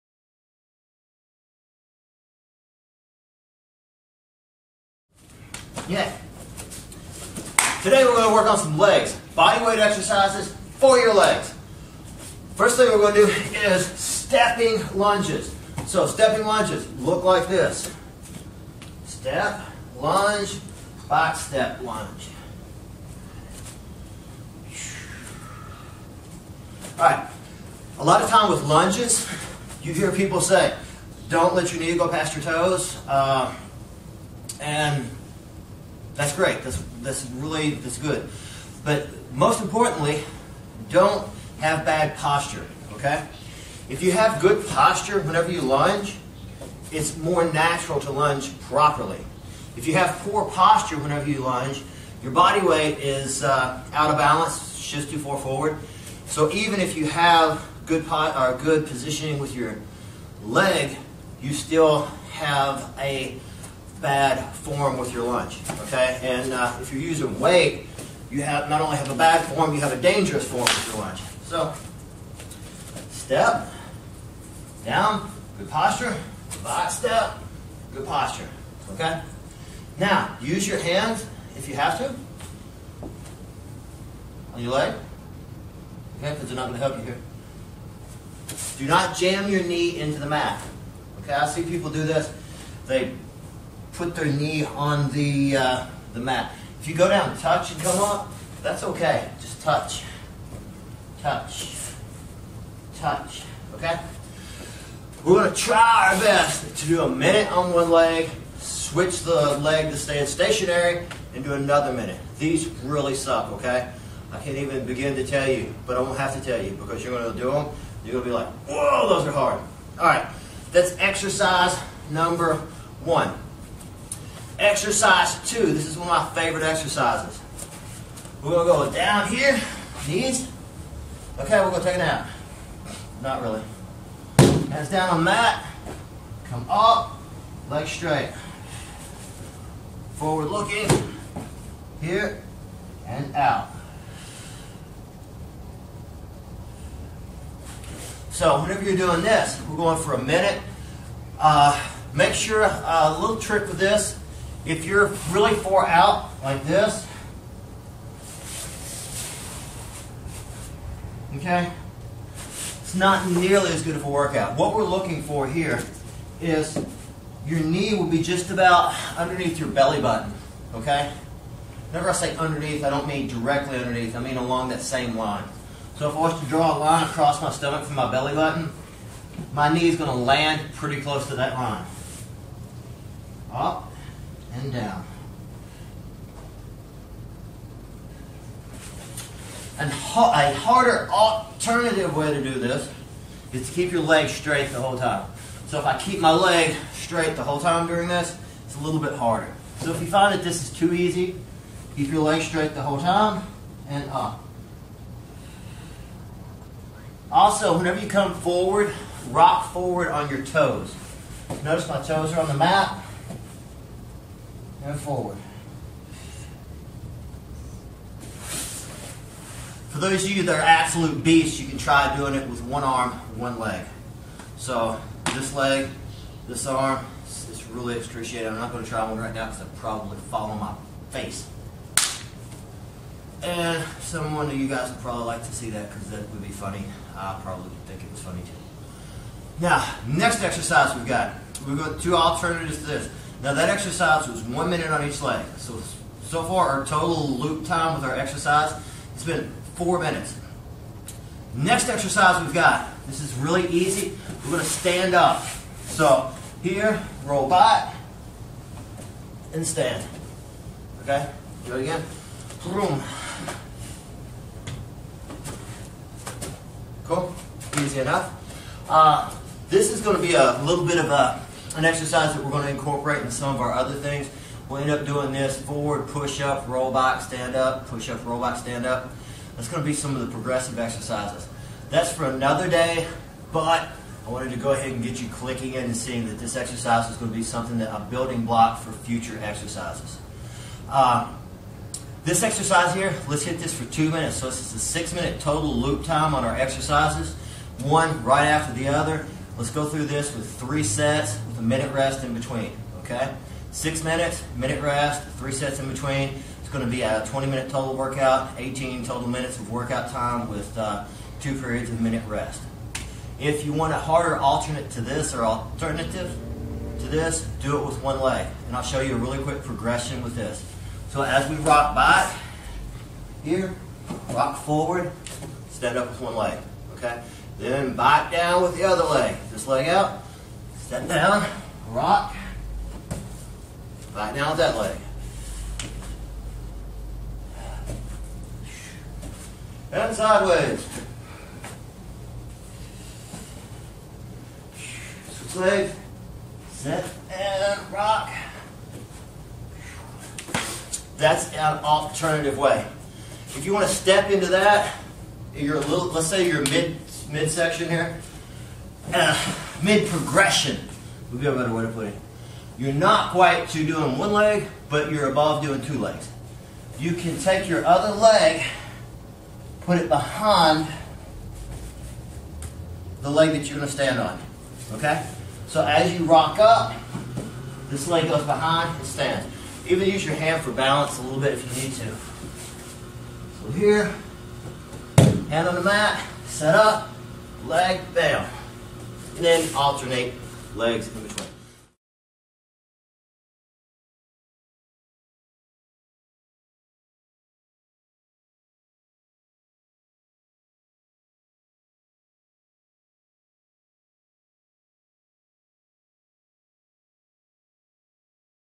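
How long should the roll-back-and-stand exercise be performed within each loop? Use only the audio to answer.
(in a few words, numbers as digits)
2 minutes.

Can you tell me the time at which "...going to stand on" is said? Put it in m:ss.
6:13.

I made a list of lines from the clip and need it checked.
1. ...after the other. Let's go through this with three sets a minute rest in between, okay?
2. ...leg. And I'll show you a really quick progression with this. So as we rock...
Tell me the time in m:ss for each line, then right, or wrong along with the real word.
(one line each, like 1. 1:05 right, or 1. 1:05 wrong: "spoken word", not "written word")
1. 4:58 right
2. 5:18 right.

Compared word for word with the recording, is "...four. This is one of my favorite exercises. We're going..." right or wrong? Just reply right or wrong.
wrong.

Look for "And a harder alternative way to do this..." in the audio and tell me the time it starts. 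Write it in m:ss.
3:09.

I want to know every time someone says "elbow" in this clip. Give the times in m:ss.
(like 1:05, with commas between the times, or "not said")
not said.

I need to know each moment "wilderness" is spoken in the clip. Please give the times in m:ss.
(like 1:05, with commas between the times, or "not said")
not said.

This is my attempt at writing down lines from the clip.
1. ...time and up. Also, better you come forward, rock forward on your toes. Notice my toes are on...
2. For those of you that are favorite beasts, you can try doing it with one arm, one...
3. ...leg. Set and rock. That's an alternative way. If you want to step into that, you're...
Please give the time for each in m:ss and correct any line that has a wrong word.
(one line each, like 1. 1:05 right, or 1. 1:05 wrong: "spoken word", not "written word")
1. 3:22 wrong: "whenever", not "better"
2. 3:39 wrong: "absolute", not "favorite"
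3. 5:45 right.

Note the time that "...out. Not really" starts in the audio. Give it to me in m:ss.
2:12.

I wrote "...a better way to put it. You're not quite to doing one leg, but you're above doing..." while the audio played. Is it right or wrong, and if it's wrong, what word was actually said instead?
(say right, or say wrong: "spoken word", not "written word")
right.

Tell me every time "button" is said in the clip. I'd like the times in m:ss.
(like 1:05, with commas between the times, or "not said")
2:49, 2:58.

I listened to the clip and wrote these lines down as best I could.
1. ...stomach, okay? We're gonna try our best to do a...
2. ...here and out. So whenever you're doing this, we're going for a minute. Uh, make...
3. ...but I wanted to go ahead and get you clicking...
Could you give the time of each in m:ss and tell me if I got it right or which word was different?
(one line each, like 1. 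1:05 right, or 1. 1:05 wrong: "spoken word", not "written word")
1. 1:42 wrong: "touch", not "stomach"
2. 2:21 right
3. 4:43 right.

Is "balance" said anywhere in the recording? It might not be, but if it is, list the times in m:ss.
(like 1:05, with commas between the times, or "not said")
0:54, 6:20.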